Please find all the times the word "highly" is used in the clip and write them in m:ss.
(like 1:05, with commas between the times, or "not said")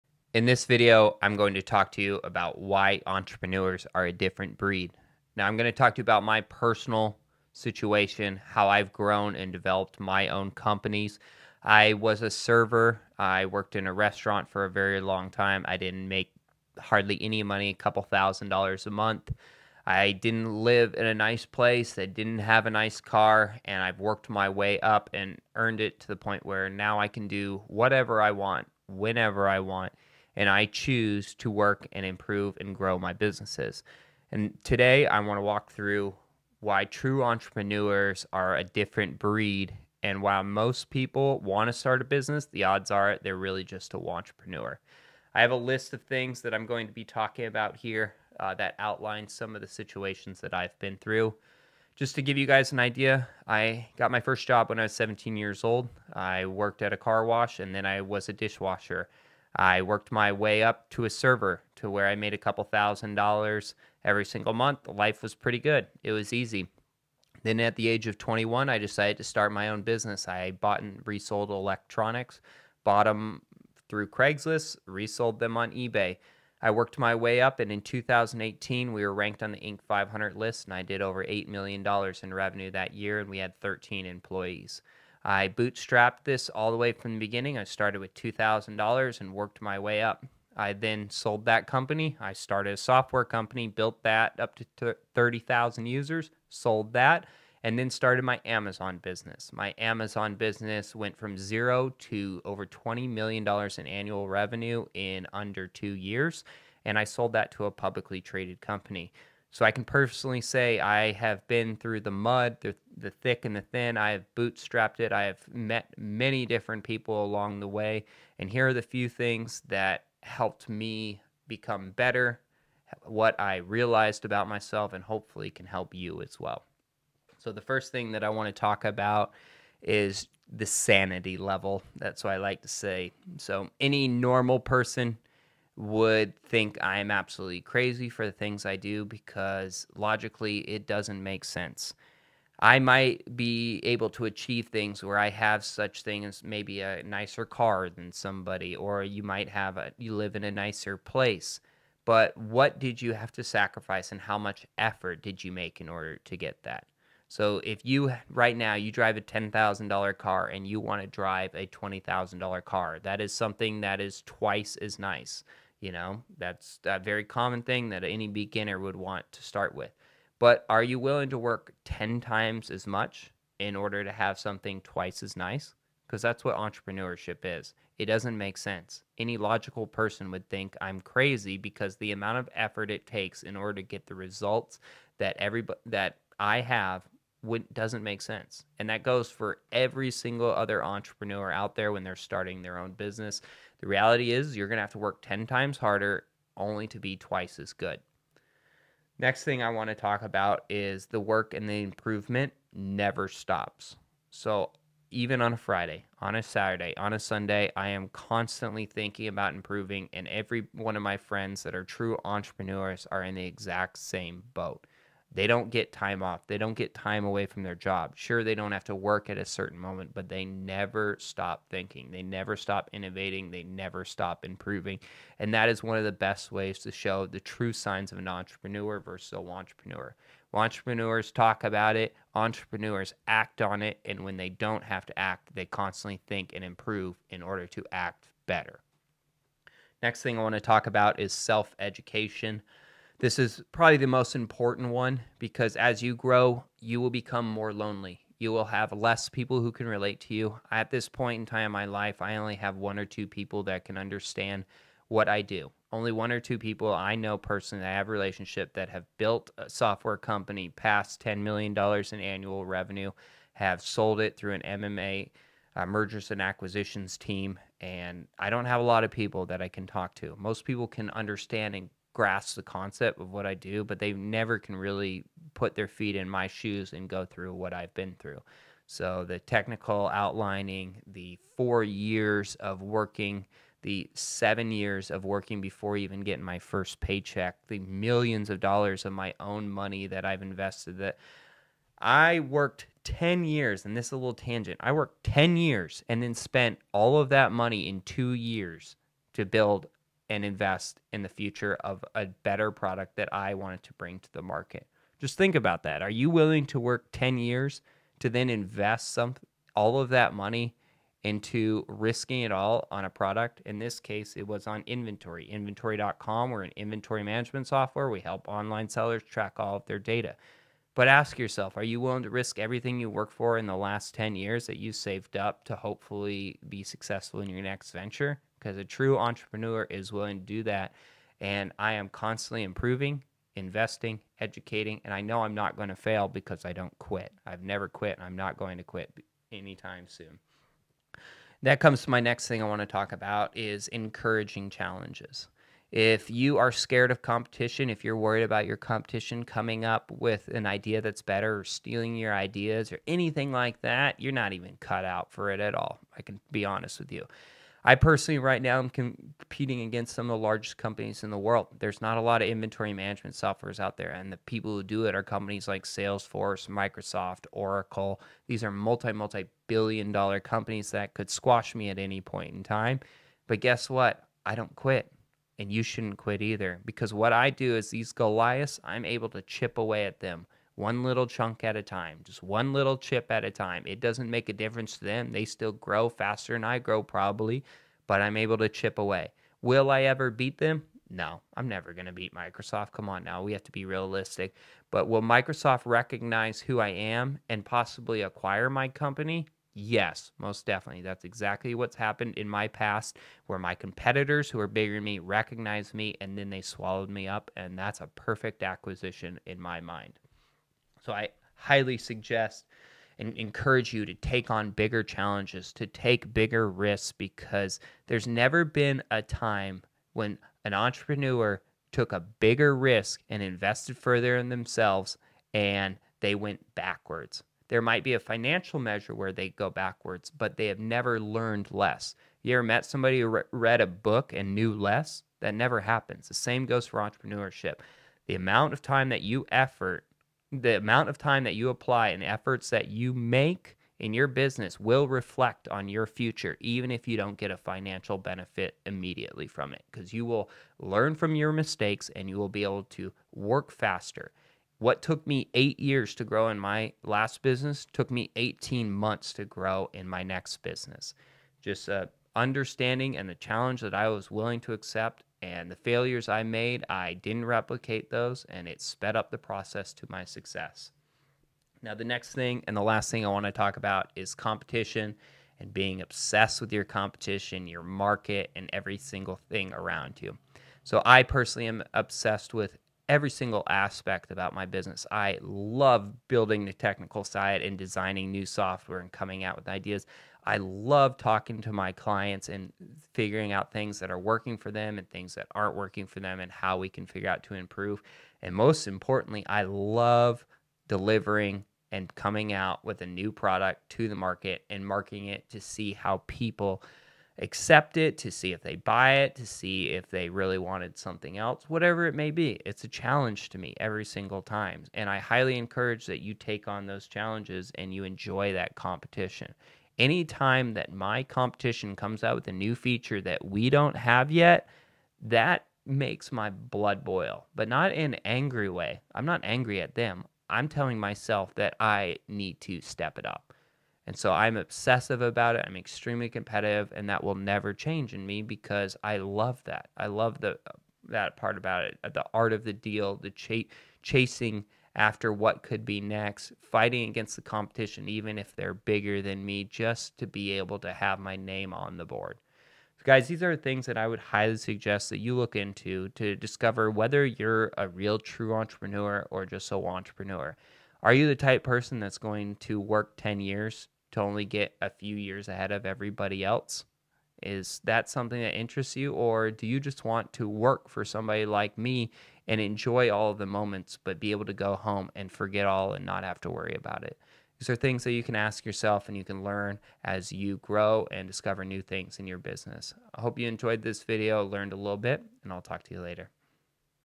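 6:51, 8:35, 9:14.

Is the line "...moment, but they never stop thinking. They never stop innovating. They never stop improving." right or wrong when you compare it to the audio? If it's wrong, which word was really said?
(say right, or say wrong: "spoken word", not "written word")
right.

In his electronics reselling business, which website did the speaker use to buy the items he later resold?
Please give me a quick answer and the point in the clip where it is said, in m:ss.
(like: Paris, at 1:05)
Craigslist, at 1:14.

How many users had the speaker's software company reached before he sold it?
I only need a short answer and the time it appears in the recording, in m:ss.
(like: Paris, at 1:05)
30,000, at 1:35.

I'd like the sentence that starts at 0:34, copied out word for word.
And today I want to walk through why true entrepreneurs are a different breed.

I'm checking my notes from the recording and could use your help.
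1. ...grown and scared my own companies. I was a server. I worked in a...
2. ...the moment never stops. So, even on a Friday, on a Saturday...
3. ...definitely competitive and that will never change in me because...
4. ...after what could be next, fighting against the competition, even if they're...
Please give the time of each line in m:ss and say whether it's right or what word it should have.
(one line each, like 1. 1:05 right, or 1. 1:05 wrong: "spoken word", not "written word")
1. 0:08 wrong: "developed", not "scared"
2. 3:21 wrong: "improvement", not "moment"
3. 8:55 wrong: "extremely", not "definitely"
4. 9:04 right.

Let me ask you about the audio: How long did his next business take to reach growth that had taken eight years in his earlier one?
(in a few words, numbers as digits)
18 months.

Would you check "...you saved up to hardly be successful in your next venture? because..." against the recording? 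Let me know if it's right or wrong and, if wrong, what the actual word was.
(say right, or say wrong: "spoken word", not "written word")
wrong: "hopefully", not "hardly".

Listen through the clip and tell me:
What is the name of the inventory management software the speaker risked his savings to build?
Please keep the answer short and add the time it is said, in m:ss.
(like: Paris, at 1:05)
Inventoryy, at 5:14.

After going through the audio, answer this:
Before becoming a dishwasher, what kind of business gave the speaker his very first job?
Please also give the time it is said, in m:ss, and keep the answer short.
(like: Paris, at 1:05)
car wash, at 0:56.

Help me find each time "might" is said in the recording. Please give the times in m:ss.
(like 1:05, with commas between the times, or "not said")
2:22, 2:29, 7:07.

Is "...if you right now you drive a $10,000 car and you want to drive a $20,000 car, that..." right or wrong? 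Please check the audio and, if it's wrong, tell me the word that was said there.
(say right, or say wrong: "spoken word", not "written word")
right.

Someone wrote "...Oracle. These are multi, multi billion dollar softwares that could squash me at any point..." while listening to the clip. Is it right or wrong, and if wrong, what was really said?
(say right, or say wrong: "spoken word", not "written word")
wrong: "companies", not "softwares".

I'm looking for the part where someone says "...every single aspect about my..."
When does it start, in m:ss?
8:03.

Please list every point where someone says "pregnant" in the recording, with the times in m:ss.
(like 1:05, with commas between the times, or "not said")
not said.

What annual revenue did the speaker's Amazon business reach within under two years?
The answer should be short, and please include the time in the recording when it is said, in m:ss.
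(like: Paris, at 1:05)
over $20 million, at 1:42.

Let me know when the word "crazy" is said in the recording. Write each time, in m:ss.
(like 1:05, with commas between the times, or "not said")
2:17, 3:00.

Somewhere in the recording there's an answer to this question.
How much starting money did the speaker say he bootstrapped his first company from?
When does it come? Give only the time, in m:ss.
1:28.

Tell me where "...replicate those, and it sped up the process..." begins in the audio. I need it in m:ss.
7:47.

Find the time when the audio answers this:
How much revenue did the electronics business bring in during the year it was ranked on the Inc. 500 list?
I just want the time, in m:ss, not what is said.
1:21.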